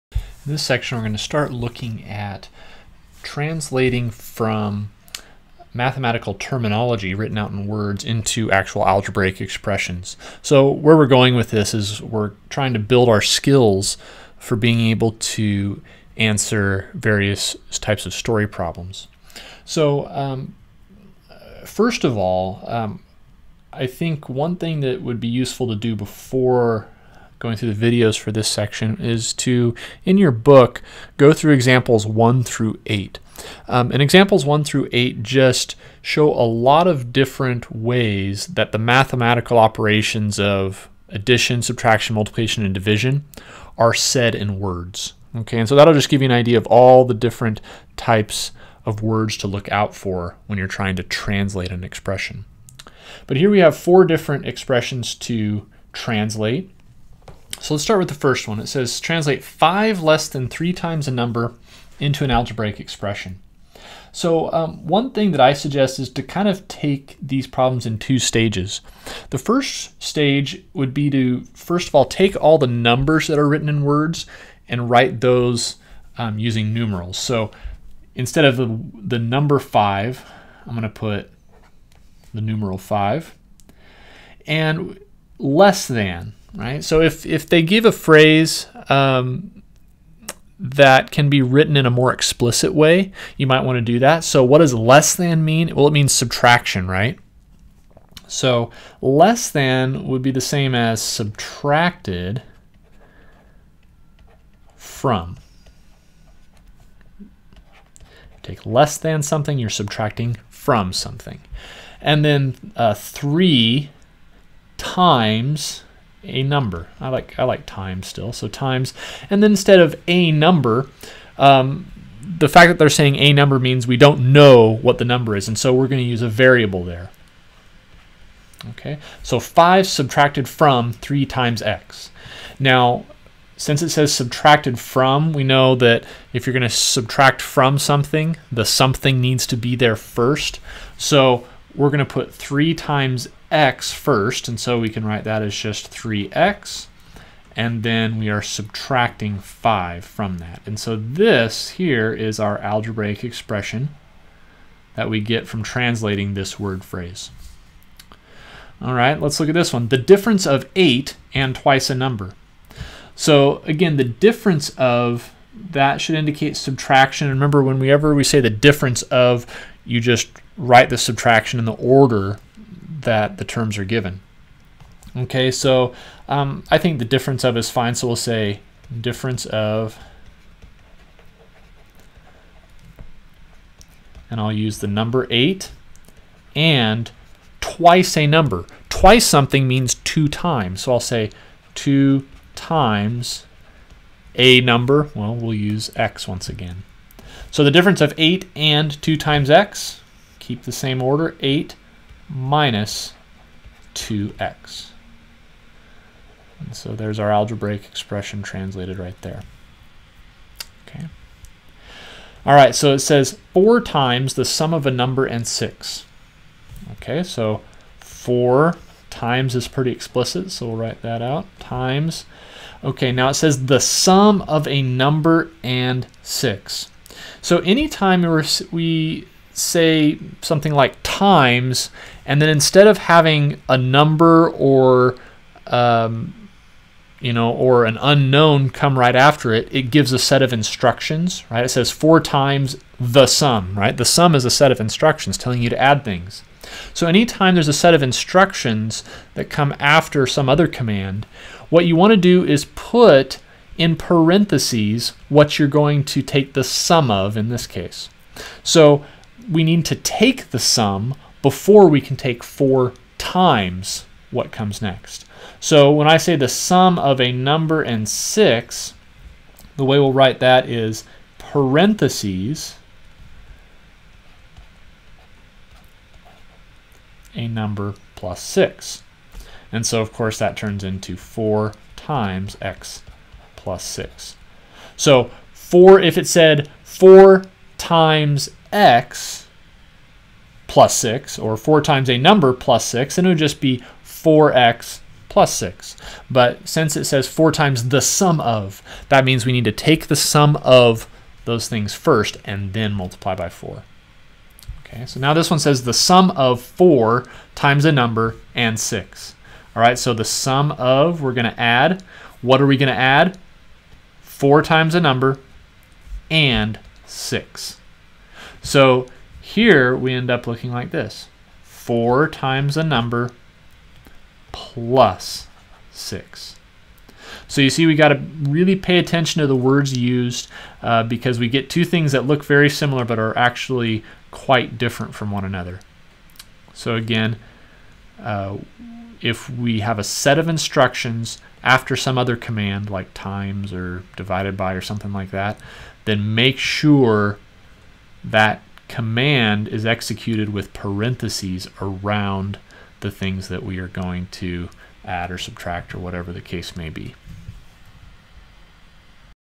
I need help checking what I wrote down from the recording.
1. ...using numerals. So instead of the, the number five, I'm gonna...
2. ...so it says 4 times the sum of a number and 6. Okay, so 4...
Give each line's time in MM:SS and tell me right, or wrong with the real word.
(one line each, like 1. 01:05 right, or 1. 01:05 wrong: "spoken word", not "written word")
1. 01:16 right
2. 03:32 right.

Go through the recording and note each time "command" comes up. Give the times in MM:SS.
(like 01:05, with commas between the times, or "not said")
04:10, 05:42, 05:48.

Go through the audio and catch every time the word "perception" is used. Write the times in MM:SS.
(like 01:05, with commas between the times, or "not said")
not said.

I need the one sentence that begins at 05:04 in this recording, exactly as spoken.
Okay, so now this one says the sum of 4 times a number and 6.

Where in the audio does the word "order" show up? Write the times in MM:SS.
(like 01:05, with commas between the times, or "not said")
02:51, 03:21.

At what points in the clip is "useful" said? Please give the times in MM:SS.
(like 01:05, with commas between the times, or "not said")
00:25.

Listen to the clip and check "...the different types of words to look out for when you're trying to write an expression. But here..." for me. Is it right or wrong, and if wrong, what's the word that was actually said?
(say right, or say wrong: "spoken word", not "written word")
wrong: "translate", not "write".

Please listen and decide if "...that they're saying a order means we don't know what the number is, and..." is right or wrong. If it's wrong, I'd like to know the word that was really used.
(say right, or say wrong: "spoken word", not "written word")
wrong: "number", not "order".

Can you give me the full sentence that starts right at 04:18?
So we need to take the sum before we can take 4 times what comes next.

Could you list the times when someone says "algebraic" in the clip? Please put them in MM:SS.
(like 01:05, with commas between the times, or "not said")
00:08, 01:02, 02:32, 03:27.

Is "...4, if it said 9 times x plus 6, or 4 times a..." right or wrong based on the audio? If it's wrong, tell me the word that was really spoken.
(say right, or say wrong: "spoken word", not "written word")
wrong: "4", not "9".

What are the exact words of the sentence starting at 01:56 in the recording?
I like I like times still, so times.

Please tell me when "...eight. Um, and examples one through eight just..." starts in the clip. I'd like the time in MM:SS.
00:32.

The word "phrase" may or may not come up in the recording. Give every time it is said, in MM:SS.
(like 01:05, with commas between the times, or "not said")
01:27, 02:36.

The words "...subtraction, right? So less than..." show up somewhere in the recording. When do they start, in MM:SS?
01:36.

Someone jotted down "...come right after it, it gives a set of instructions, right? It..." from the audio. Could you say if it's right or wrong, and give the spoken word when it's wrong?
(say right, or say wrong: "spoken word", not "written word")
right.